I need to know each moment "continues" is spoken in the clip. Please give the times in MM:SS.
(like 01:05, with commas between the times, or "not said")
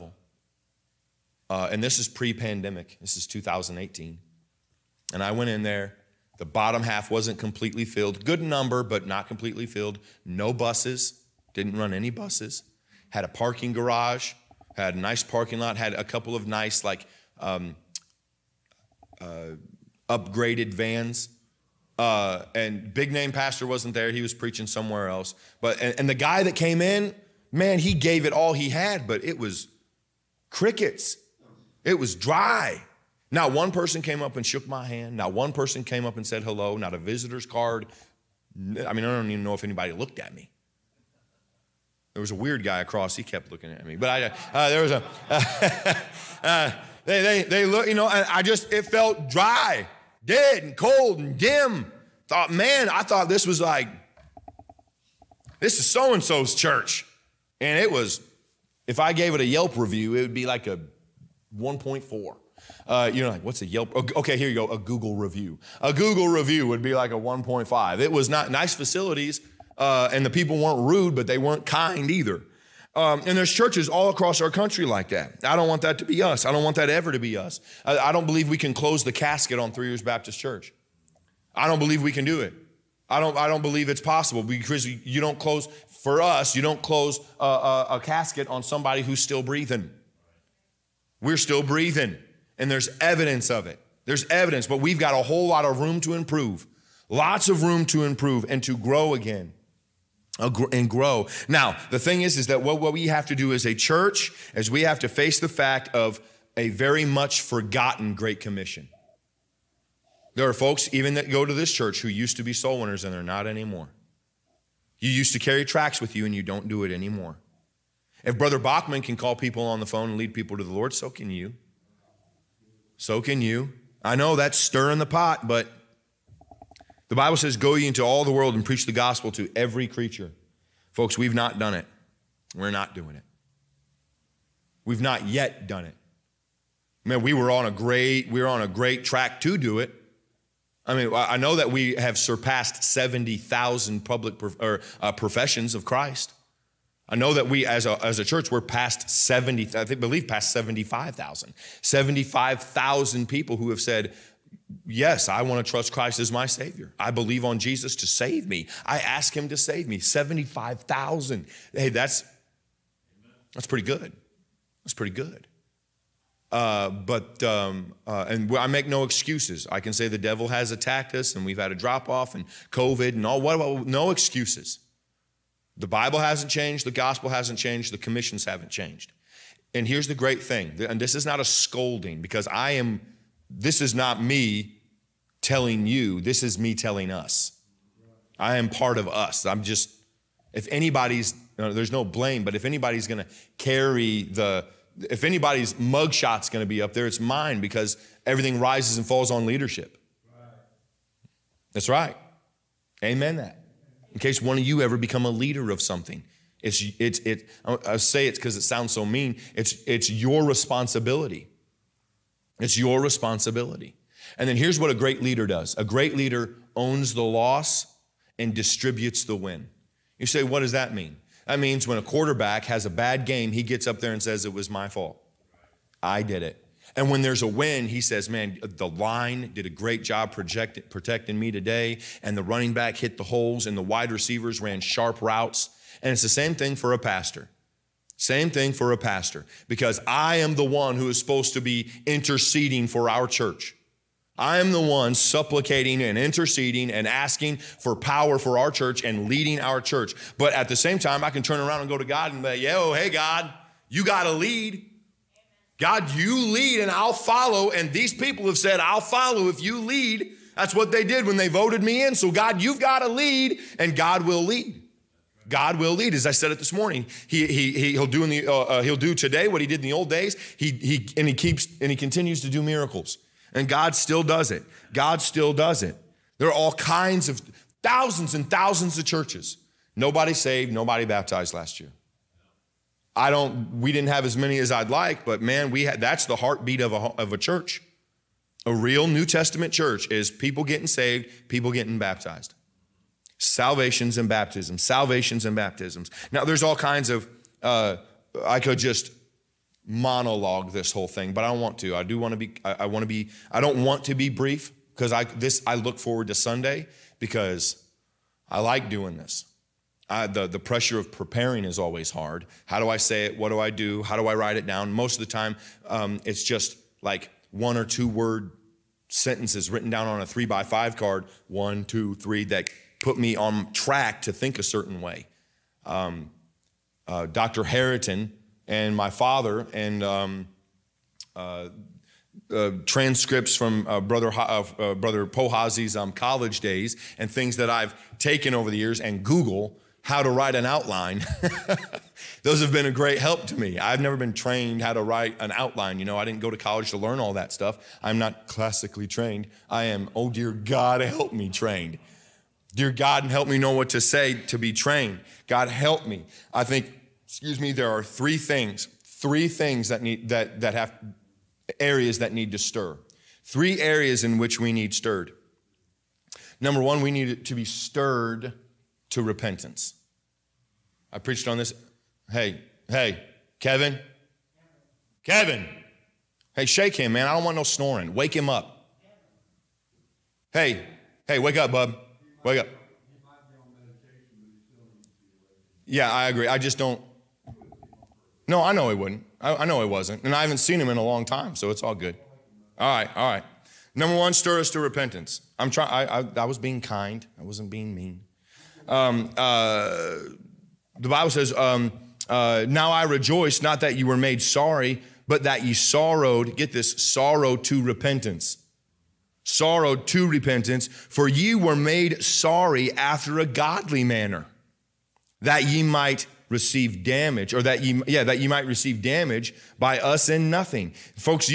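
04:31.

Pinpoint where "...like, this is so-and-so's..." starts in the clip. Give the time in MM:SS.
00:53.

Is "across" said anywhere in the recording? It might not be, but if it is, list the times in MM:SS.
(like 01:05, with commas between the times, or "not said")
00:42, 01:14.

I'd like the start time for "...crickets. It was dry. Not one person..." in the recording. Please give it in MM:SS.
00:30.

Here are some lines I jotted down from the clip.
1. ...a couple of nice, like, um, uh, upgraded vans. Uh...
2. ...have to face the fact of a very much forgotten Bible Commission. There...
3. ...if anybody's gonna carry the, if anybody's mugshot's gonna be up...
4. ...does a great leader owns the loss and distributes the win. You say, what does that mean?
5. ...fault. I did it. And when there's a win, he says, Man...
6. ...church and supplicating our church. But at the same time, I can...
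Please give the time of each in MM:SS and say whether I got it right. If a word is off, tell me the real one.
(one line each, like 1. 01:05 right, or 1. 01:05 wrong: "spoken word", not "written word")
1. 00:15 right
2. 01:44 wrong: "Great", not "Bible"
3. 03:12 right
4. 03:35 right
5. 03:44 right
6. 04:08 wrong: "leading", not "supplicating".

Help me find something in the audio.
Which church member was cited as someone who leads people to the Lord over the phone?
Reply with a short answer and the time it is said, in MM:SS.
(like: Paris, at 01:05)
Brother Bachman, at 01:58.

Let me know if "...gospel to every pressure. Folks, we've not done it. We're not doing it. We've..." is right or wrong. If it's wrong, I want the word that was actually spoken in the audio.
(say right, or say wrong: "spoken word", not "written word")
wrong: "creature", not "pressure".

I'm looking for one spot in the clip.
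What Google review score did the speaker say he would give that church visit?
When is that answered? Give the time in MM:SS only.
01:07.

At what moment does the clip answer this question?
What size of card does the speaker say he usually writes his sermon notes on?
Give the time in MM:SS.
05:20.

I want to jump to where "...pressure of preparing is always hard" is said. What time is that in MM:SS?
05:10.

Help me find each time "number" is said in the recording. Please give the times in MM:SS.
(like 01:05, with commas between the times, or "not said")
00:08, 06:06, 06:33.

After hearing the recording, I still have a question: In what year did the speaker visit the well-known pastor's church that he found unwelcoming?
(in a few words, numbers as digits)
2018.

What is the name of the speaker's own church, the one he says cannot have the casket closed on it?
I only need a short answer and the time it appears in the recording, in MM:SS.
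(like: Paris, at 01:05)
Three Rivers Baptist Church, at 01:19.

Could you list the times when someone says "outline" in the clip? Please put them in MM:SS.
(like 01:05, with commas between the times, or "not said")
05:40, 05:45.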